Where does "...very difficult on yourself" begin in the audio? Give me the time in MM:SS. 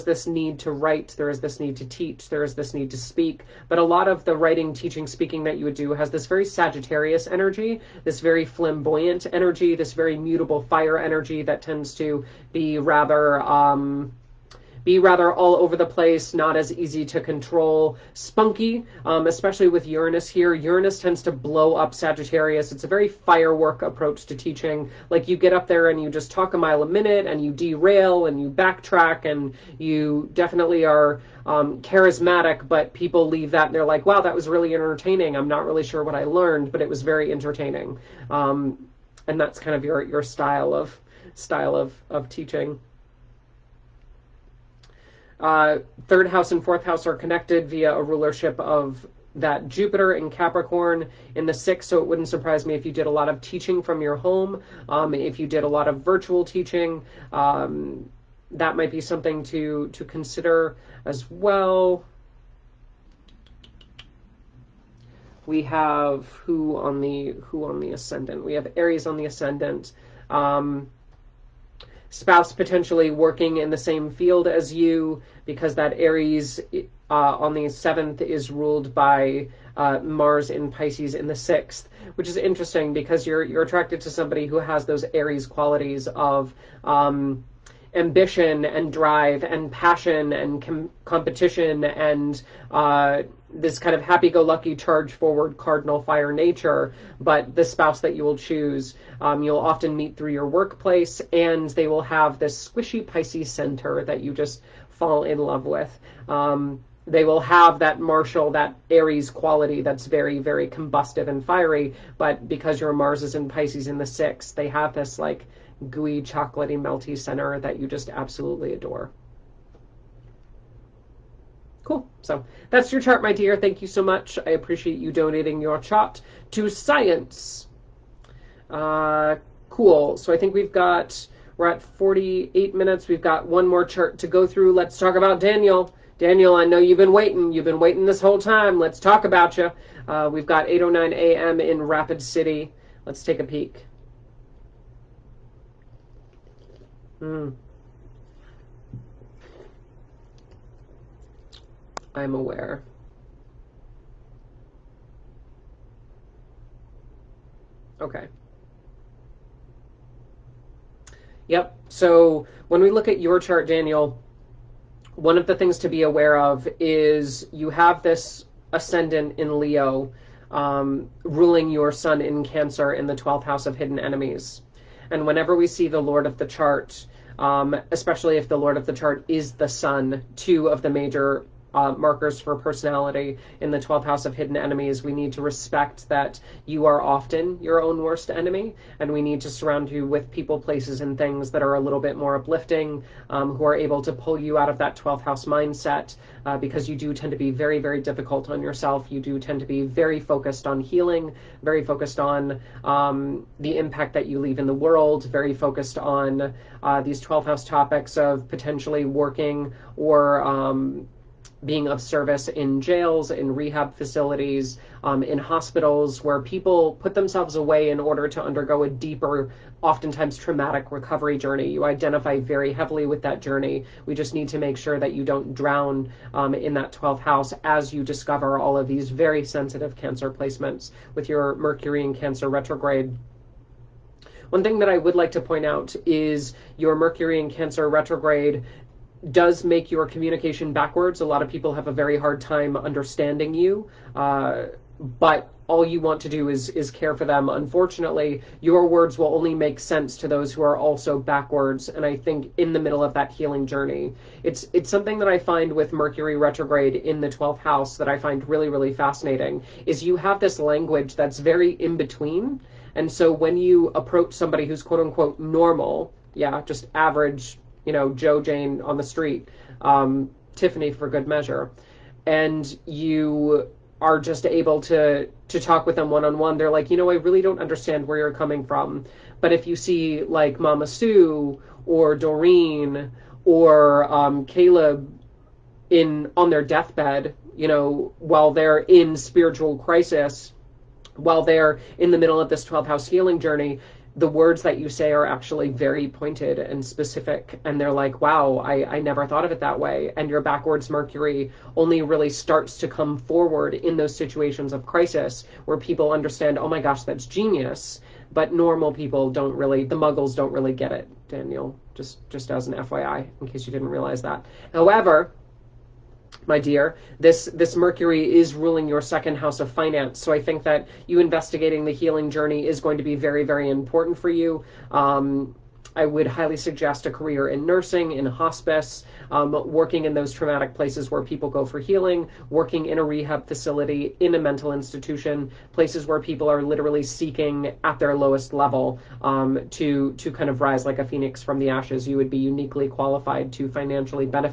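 03:17.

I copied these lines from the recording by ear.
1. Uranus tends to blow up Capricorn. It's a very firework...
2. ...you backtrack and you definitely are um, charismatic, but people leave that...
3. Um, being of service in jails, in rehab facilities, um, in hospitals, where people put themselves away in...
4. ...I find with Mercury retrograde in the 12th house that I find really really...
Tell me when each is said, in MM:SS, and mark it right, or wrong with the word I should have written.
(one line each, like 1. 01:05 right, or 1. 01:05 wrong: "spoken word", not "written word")
1. 00:20 wrong: "Sagittarius", not "Capricorn"
2. 00:28 right
3. 03:30 right
4. 04:15 right.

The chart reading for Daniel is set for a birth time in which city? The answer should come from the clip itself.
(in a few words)
Rapid City.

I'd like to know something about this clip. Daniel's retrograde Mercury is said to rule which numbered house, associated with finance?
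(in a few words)
Second house.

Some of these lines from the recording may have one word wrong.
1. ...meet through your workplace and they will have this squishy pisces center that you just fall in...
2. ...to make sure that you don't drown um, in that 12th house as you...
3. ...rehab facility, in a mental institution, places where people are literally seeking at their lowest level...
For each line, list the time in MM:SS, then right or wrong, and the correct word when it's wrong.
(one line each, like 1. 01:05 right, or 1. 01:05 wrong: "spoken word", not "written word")
1. 01:39 right
2. 03:44 right
3. 05:33 right.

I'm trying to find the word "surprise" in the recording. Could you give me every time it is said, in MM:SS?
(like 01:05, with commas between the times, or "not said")
00:52.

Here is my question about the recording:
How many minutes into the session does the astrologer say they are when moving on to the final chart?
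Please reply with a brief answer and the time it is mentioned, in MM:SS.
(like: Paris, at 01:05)
48, at 02:11.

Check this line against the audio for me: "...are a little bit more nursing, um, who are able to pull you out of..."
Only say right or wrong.
wrong.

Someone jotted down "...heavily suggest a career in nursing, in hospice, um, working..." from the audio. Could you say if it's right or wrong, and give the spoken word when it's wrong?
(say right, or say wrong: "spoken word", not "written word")
wrong: "highly", not "heavily".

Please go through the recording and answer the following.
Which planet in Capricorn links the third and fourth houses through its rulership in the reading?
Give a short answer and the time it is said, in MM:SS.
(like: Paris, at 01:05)
Jupiter, at 00:49.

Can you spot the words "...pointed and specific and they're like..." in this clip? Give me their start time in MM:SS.
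04:56.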